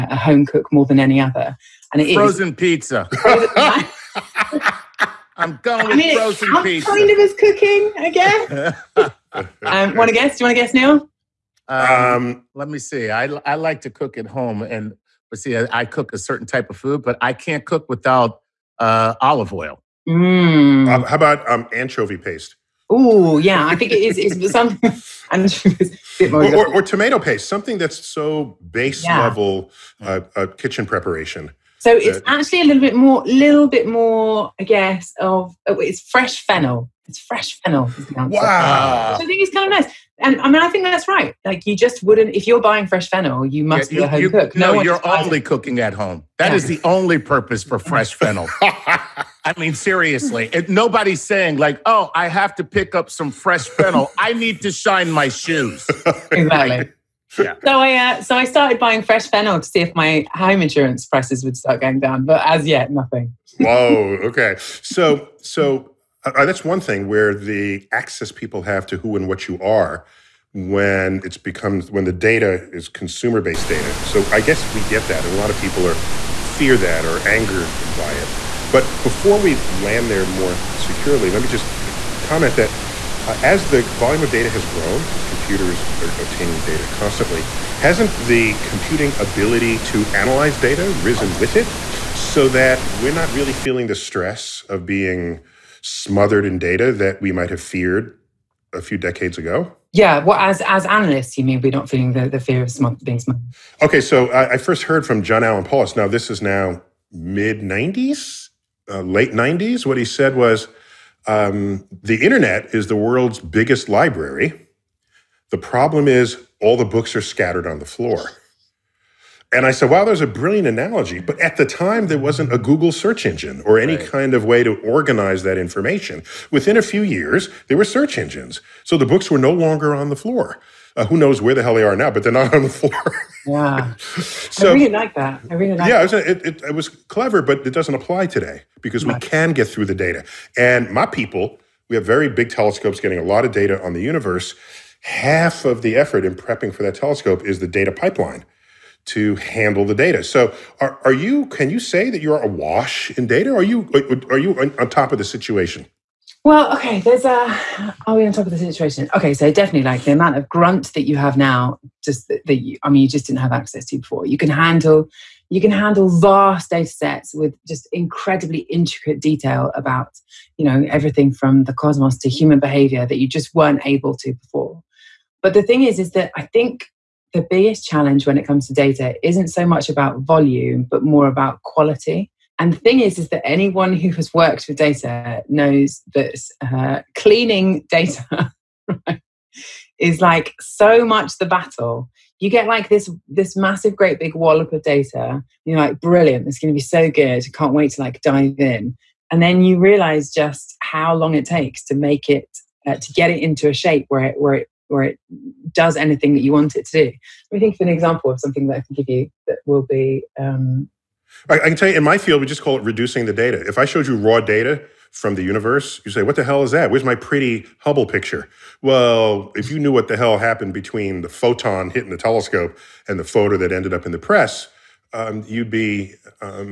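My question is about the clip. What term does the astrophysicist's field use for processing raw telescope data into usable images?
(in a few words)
Reducing the data.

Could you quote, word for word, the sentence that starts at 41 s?
Like, you just wouldn't, if you're buying fresh fennel, you must yeah, you, be a home you, cook.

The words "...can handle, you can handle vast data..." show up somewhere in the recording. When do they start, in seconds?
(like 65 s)
164 s.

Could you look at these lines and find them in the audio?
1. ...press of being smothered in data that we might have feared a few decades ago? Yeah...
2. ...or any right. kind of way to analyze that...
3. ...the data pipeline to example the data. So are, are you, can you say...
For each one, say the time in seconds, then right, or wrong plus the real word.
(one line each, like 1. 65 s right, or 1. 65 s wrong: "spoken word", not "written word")
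1. 93 s wrong: "stress", not "press"
2. 123 s wrong: "organize", not "analyze"
3. 147 s wrong: "handle", not "example".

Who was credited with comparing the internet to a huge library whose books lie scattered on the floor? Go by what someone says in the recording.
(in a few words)
John Allen Paulos.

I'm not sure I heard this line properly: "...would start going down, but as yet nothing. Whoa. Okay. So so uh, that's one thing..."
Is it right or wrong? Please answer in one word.
right.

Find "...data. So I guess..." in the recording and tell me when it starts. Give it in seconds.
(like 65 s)
73 s.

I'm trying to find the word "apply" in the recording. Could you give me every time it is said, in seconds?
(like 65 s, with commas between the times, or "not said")
137 s.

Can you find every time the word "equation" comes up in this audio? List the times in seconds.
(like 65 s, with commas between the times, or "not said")
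not said.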